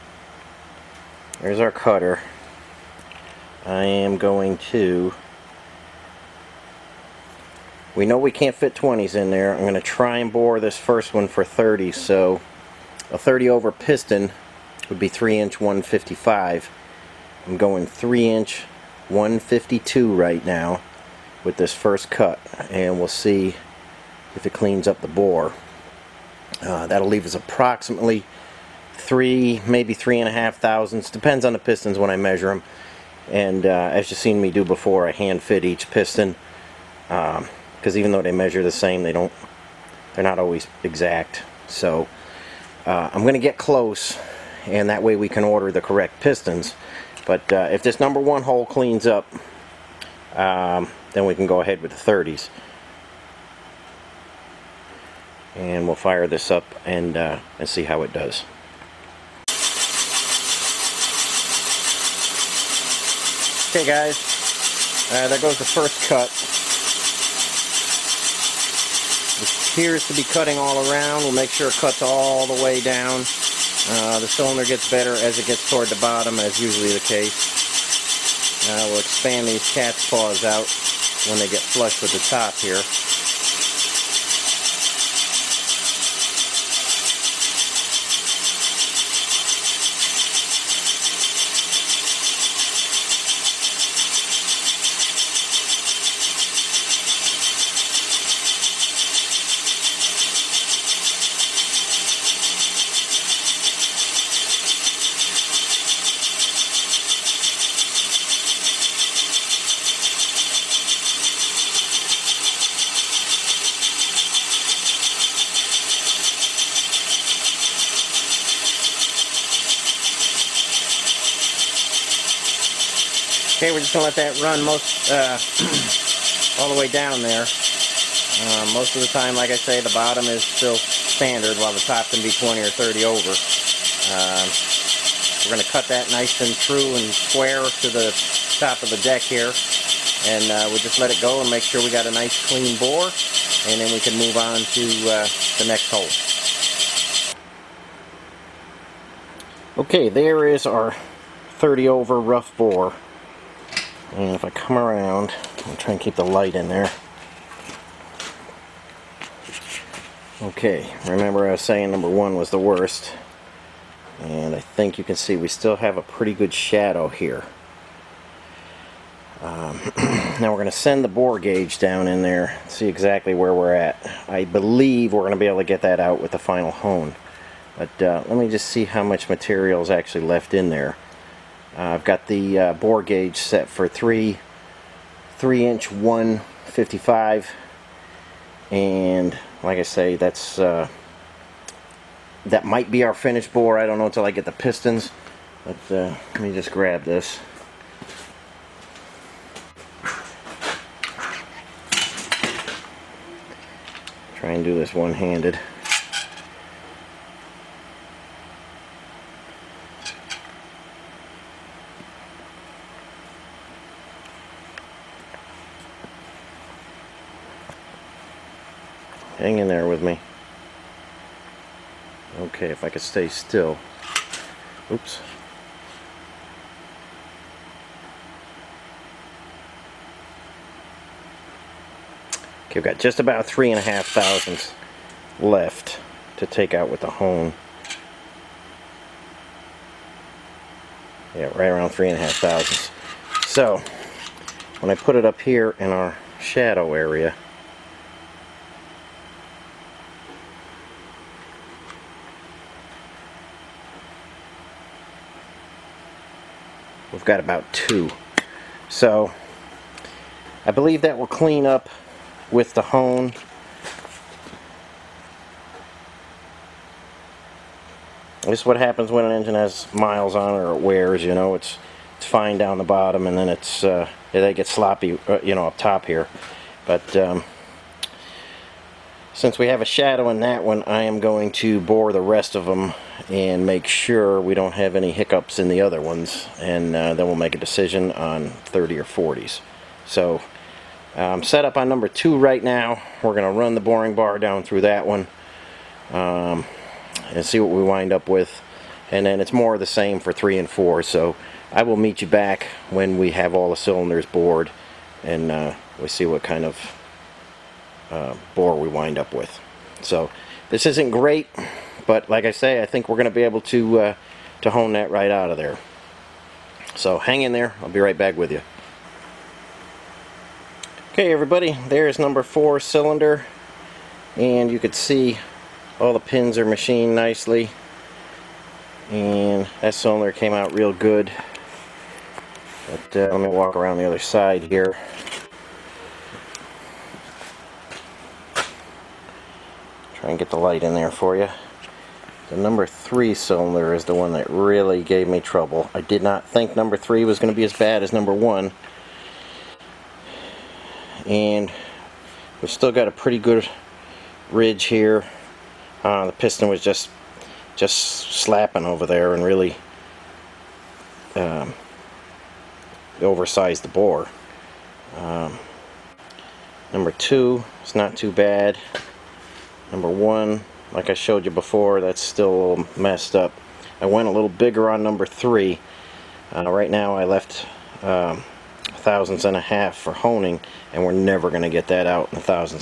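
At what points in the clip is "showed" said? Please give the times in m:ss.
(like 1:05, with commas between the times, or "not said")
6:11.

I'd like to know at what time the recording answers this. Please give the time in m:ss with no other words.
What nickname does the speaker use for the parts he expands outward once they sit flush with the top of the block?
1:19.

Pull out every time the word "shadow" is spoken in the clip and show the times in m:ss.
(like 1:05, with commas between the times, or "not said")
2:46, 4:06, 4:39.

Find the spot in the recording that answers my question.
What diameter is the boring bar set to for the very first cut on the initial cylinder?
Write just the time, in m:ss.
0:17.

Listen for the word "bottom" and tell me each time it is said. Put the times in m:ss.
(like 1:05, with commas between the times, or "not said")
1:15, 2:09, 4:32.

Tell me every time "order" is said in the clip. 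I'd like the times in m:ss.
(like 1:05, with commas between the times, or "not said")
0:45.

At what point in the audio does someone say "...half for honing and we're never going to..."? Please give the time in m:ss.
6:19.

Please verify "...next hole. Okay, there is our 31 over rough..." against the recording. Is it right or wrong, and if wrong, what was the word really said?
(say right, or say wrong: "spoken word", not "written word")
wrong: "30", not "31".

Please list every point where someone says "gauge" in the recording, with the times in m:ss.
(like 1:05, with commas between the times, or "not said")
2:51, 3:03.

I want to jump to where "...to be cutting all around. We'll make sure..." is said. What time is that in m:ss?
1:10.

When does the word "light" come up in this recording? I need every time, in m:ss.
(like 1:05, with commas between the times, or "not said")
2:36, 5:40.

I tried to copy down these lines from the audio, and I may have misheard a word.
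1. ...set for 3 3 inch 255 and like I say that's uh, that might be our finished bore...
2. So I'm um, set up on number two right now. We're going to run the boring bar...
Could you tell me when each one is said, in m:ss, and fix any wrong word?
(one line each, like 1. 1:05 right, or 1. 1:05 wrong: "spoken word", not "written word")
1. 3:03 wrong: "155", not "255"
2. 4:50 right.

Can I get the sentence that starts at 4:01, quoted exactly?
Yeah, right around three and a half thousandths.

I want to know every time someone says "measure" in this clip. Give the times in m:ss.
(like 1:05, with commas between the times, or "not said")
0:32, 0:38.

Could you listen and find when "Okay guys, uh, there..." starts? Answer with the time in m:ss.
1:03.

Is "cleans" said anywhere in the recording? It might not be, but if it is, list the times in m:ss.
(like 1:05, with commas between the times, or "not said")
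0:24, 0:48, 2:22, 4:21.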